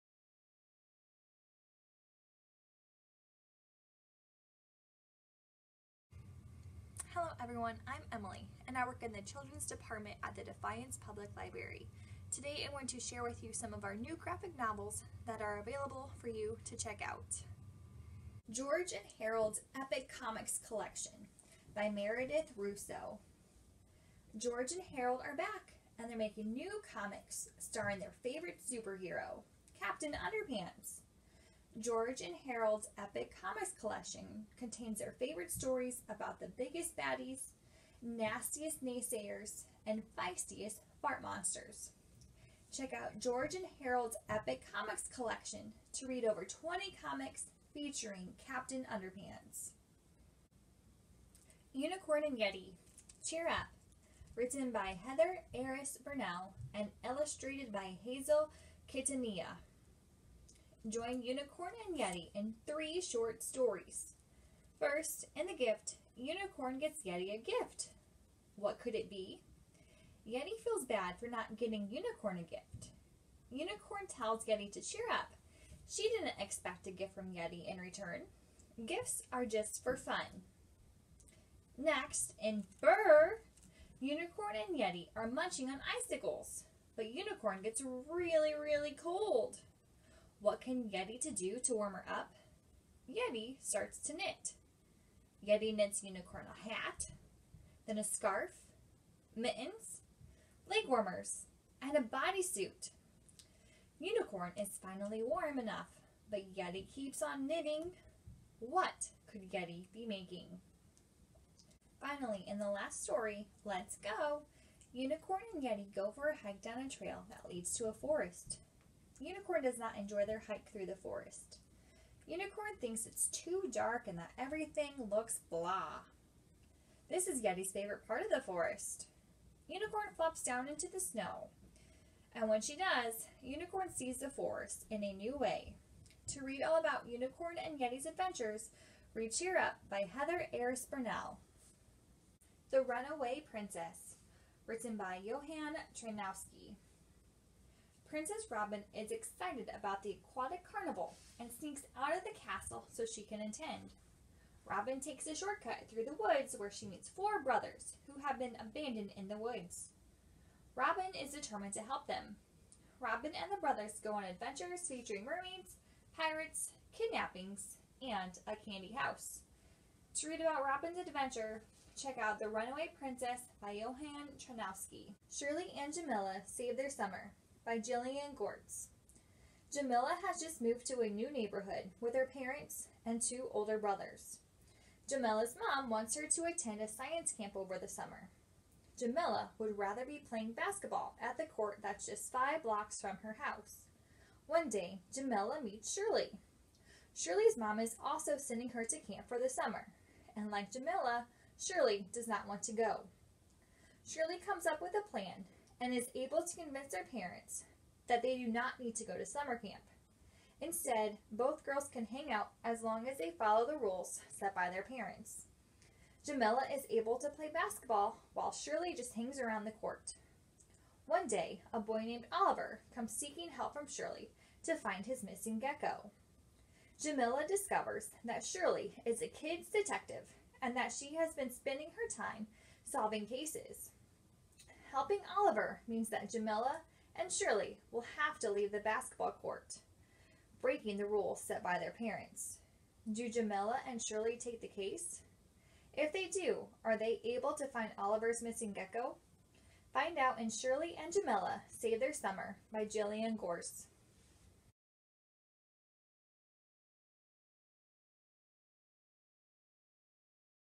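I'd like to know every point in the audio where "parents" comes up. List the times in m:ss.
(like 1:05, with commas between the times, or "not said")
3:02, 3:27, 3:34, 4:01.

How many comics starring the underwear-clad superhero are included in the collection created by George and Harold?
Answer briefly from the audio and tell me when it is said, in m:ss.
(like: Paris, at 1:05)
over 20, at 0:46.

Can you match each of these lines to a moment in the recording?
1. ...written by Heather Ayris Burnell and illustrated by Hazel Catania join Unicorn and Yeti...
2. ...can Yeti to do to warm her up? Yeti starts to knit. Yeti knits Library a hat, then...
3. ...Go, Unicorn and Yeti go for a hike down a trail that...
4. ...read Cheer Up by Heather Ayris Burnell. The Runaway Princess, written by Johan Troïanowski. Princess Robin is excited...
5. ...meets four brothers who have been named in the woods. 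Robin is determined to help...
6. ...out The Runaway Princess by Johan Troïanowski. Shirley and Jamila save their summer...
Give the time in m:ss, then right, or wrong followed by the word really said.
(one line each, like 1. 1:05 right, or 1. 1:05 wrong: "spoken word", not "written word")
1. 0:54 right
2. 1:30 wrong: "Unicorn", not "Library"
3. 1:53 right
4. 2:19 right
5. 2:36 wrong: "abandoned", not "named"
6. 2:52 right.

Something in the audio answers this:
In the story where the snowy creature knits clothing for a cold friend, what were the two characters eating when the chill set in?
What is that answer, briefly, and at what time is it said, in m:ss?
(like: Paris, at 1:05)
icicles, at 1:25.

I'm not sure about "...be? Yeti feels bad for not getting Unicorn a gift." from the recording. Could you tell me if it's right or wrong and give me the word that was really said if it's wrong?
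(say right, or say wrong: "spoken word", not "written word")
right.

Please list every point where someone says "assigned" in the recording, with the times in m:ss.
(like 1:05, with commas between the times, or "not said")
not said.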